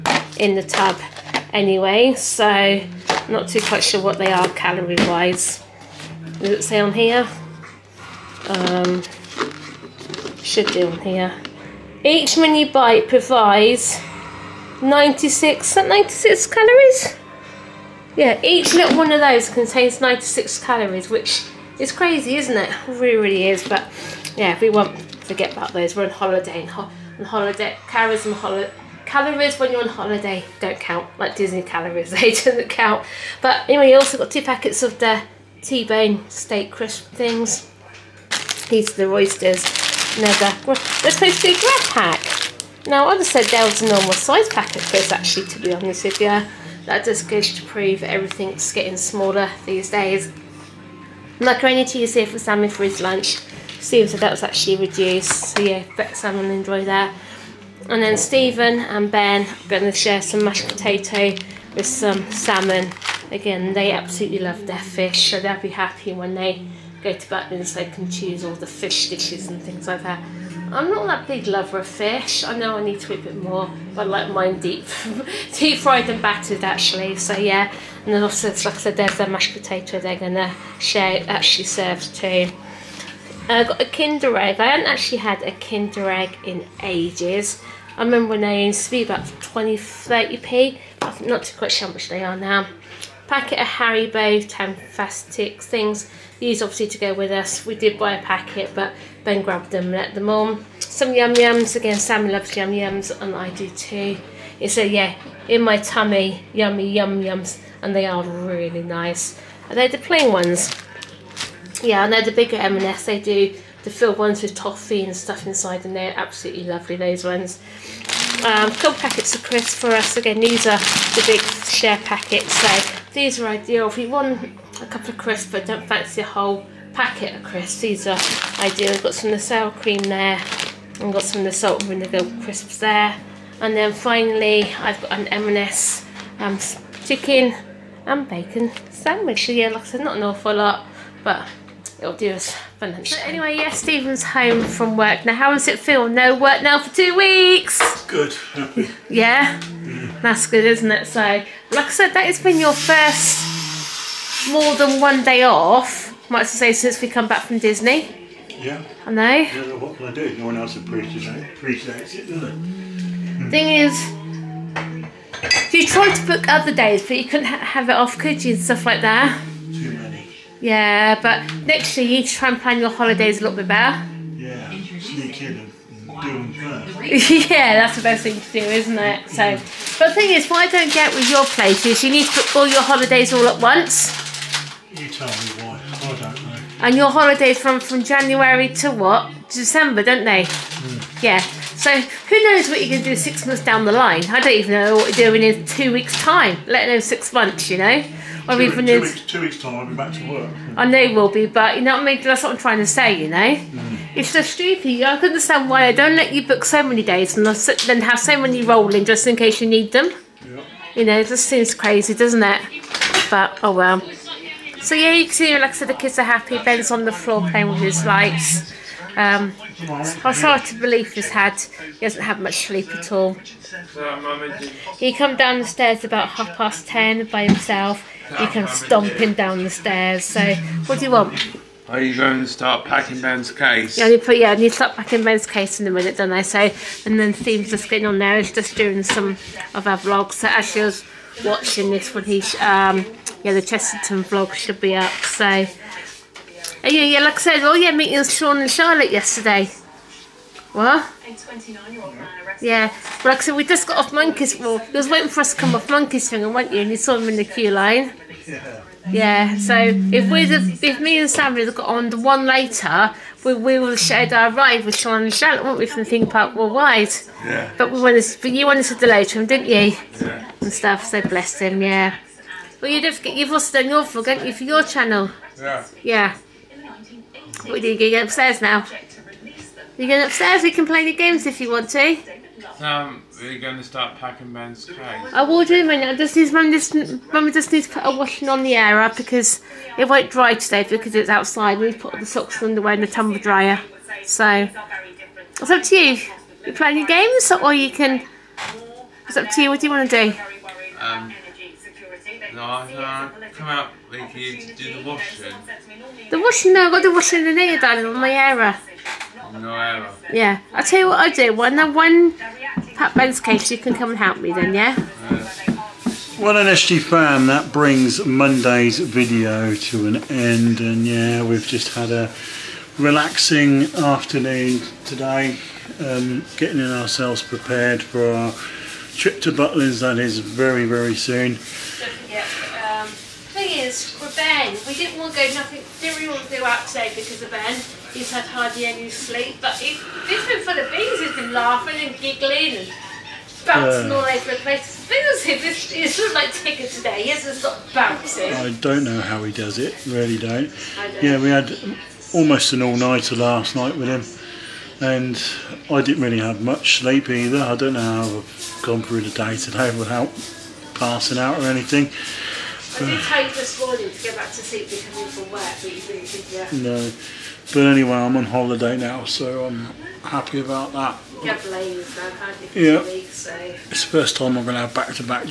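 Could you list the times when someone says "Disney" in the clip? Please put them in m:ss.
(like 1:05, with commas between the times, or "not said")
0:31, 2:37.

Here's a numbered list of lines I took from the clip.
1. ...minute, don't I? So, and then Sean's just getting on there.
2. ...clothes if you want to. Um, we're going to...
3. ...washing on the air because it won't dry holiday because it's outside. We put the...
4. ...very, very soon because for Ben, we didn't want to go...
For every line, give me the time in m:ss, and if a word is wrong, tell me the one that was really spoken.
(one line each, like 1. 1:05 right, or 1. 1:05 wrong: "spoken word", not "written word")
1. 3:55 wrong: "Steve", not "Sean"
2. 4:41 wrong: "games", not "clothes"
3. 4:48 wrong: "today", not "holiday"
4. 5:30 right.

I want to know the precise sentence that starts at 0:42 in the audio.
Now, I just said there was a normal size packet for this, actually, to be honest with you.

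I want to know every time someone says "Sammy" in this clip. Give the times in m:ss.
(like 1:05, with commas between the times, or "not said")
0:52.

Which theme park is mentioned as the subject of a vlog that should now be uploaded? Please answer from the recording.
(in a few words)
Chessington.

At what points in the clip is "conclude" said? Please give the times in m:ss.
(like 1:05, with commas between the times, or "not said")
not said.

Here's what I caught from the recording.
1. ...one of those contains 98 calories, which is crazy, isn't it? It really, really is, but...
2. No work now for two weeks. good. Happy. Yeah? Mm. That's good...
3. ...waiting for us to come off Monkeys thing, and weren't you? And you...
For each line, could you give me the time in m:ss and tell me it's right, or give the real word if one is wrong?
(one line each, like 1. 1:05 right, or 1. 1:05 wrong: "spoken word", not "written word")
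1. 0:18 wrong: "96", not "98"
2. 2:26 right
3. 4:15 right.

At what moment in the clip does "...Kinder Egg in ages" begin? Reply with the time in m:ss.
1:25.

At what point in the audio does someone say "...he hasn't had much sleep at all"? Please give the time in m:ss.
3:41.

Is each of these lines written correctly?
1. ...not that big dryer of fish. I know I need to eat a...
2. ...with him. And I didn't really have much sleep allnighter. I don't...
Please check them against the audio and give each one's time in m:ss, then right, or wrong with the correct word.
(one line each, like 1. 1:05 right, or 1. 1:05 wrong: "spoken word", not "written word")
1. 1:10 wrong: "lover", not "dryer"
2. 5:53 wrong: "either", not "allnighter".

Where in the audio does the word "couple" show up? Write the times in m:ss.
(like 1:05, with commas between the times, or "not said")
1:58, 2:04.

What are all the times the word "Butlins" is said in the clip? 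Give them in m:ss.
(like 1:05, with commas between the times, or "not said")
1:07, 5:29.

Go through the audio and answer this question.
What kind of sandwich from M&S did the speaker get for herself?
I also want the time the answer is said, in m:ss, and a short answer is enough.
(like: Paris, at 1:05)
Chicken and bacon, at 2:17.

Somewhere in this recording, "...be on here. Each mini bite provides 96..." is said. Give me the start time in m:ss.
0:10.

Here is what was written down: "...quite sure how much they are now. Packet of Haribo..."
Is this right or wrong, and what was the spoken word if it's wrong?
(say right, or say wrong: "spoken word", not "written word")
right.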